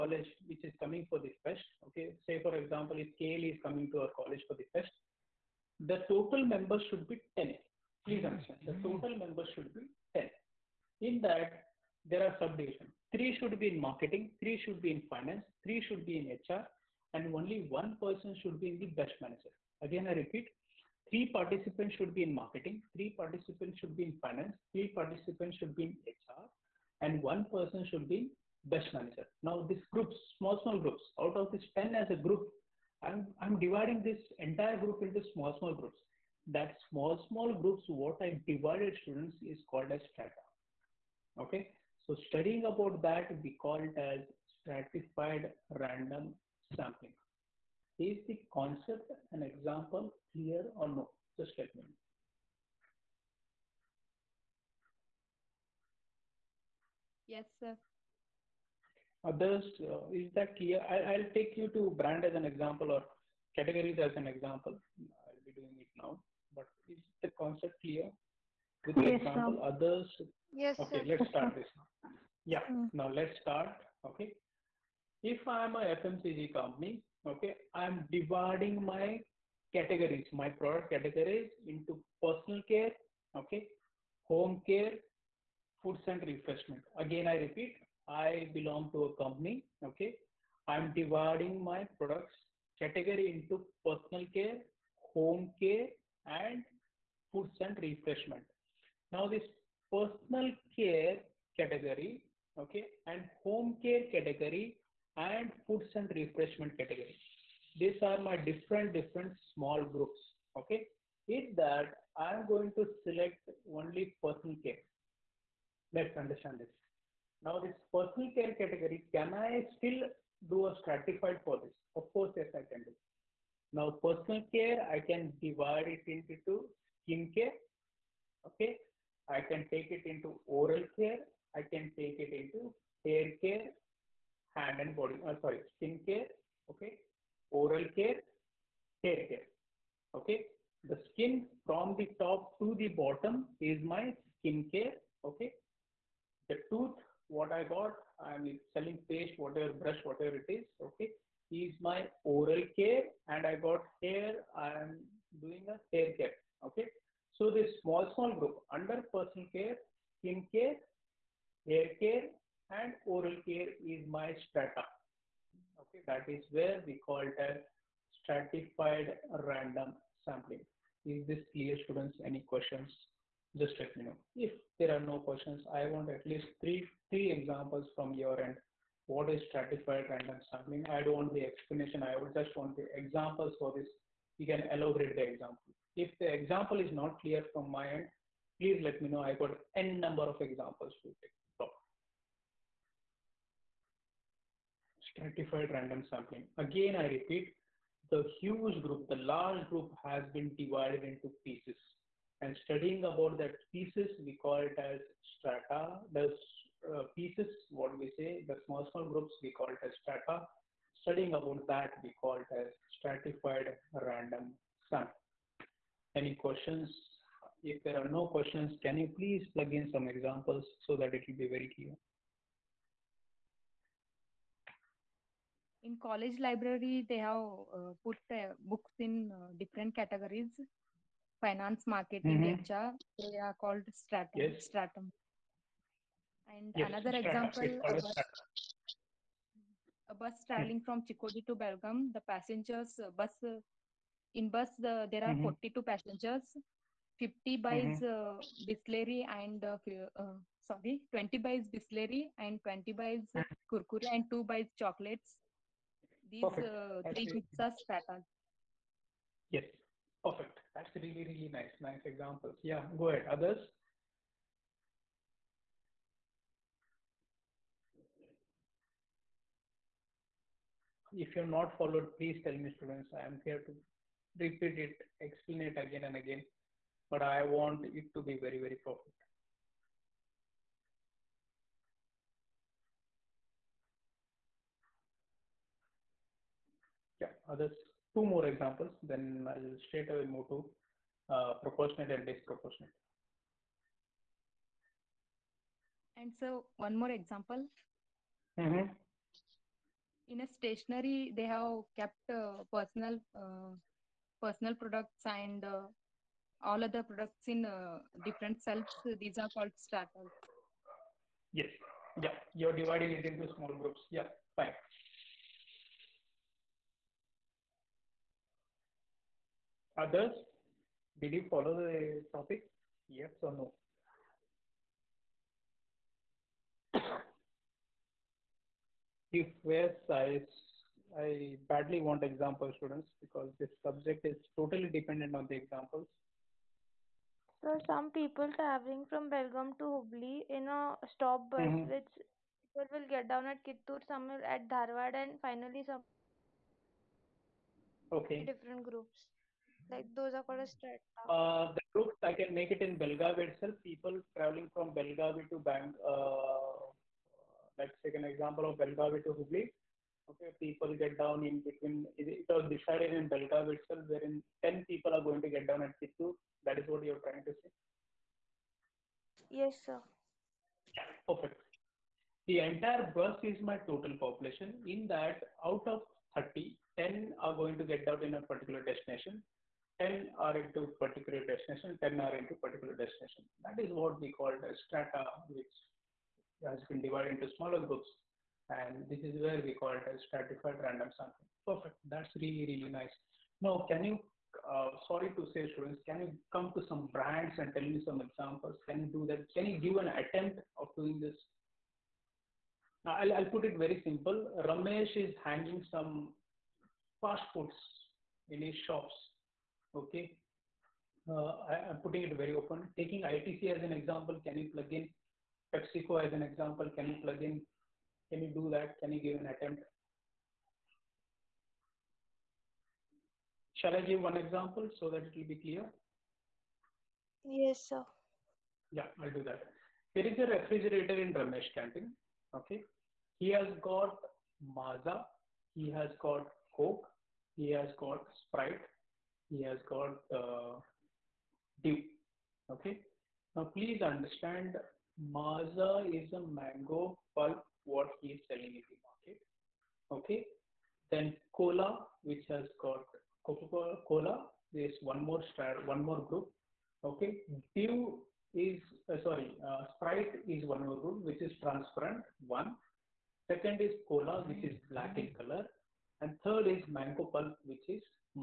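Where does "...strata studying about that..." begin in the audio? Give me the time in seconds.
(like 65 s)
210 s.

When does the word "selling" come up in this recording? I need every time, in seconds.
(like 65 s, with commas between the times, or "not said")
148 s, 448 s.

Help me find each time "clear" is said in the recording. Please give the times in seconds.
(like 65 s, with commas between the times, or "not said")
50 s, 60 s, 67 s, 171 s, 187 s, 221 s, 425 s.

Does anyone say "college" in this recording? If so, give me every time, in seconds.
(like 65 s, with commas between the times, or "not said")
4 s, 226 s.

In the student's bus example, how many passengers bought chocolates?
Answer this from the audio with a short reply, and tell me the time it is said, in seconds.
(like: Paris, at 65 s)
2, at 254 s.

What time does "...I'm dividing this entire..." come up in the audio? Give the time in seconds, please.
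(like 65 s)
33 s.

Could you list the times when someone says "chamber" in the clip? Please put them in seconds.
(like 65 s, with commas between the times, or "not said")
not said.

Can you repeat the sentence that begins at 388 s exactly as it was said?
And this is where we call it as stratified random sampling.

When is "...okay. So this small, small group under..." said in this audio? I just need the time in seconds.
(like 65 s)
156 s.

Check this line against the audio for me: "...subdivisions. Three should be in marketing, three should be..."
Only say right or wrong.
right.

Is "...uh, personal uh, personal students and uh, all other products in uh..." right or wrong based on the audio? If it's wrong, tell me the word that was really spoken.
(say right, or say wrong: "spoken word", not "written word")
wrong: "products", not "students".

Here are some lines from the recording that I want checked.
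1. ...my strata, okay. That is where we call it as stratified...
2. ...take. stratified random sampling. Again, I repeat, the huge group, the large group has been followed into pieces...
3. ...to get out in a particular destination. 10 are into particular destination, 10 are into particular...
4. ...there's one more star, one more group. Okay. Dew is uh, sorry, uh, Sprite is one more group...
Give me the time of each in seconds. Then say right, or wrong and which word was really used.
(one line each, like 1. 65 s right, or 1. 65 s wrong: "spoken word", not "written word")
1. 164 s right
2. 191 s wrong: "divided", not "followed"
3. 377 s right
4. 454 s right.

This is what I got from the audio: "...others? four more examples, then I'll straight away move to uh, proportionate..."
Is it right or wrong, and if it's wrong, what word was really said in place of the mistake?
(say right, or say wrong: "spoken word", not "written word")
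wrong: "two", not "four".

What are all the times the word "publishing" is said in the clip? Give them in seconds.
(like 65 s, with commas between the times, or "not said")
not said.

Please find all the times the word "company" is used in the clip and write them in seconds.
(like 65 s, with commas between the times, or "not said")
76 s, 89 s.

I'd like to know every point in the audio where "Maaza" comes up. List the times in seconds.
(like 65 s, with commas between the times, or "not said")
434 s, 445 s.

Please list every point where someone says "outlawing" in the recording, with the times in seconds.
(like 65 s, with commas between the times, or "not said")
not said.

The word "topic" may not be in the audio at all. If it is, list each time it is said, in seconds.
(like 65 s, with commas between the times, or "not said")
322 s.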